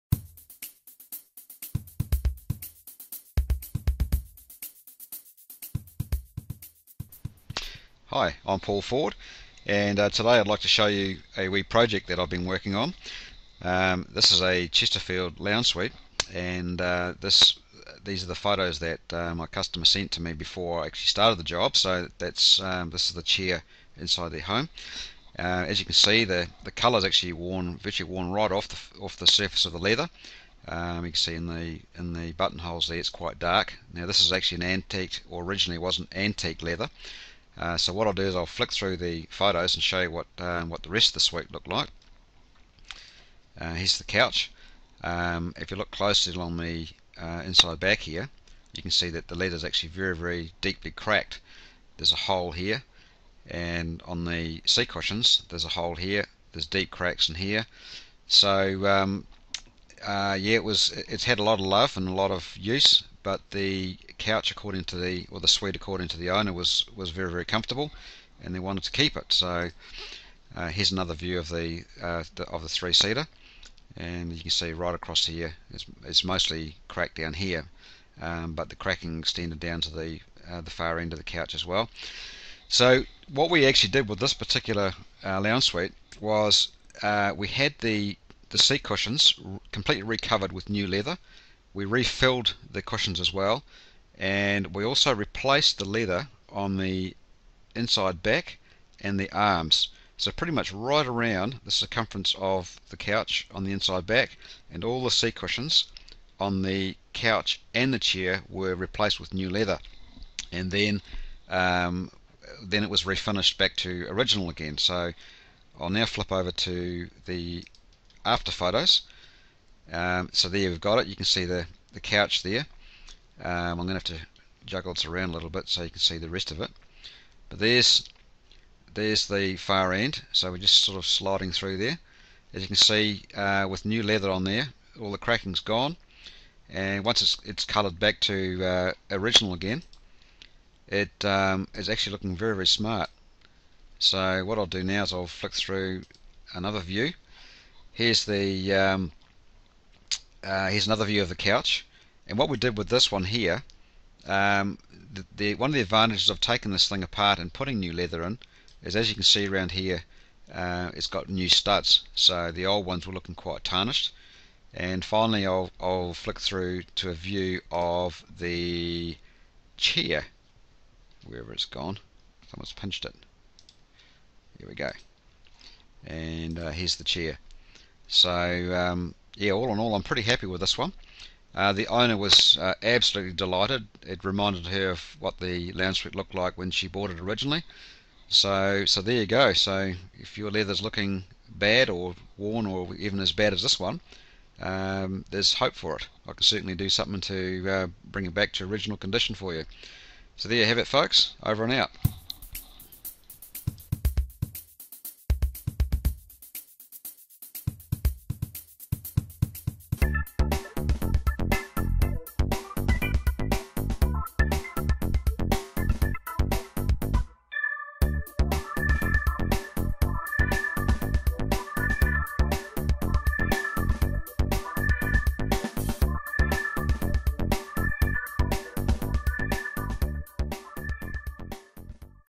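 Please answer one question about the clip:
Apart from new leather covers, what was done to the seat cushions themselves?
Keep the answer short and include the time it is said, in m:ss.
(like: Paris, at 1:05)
Refilled, at 1:31.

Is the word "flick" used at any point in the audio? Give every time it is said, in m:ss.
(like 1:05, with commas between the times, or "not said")
0:38, 2:25, 2:46.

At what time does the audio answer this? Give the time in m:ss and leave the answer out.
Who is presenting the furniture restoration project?
0:08.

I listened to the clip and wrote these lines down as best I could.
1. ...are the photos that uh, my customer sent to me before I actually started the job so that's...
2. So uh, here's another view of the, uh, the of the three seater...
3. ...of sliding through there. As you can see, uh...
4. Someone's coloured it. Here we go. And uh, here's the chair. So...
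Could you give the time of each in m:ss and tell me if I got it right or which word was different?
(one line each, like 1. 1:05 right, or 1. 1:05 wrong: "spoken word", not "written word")
1. 0:18 right
2. 1:09 right
3. 2:10 right
4. 2:52 wrong: "pinched", not "coloured".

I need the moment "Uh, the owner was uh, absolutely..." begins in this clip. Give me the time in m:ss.
3:01.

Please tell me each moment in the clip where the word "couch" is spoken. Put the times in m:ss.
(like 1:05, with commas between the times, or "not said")
0:44, 1:04, 1:21, 1:42, 1:47, 2:01, 2:31.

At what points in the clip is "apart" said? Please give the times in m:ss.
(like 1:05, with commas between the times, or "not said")
2:37.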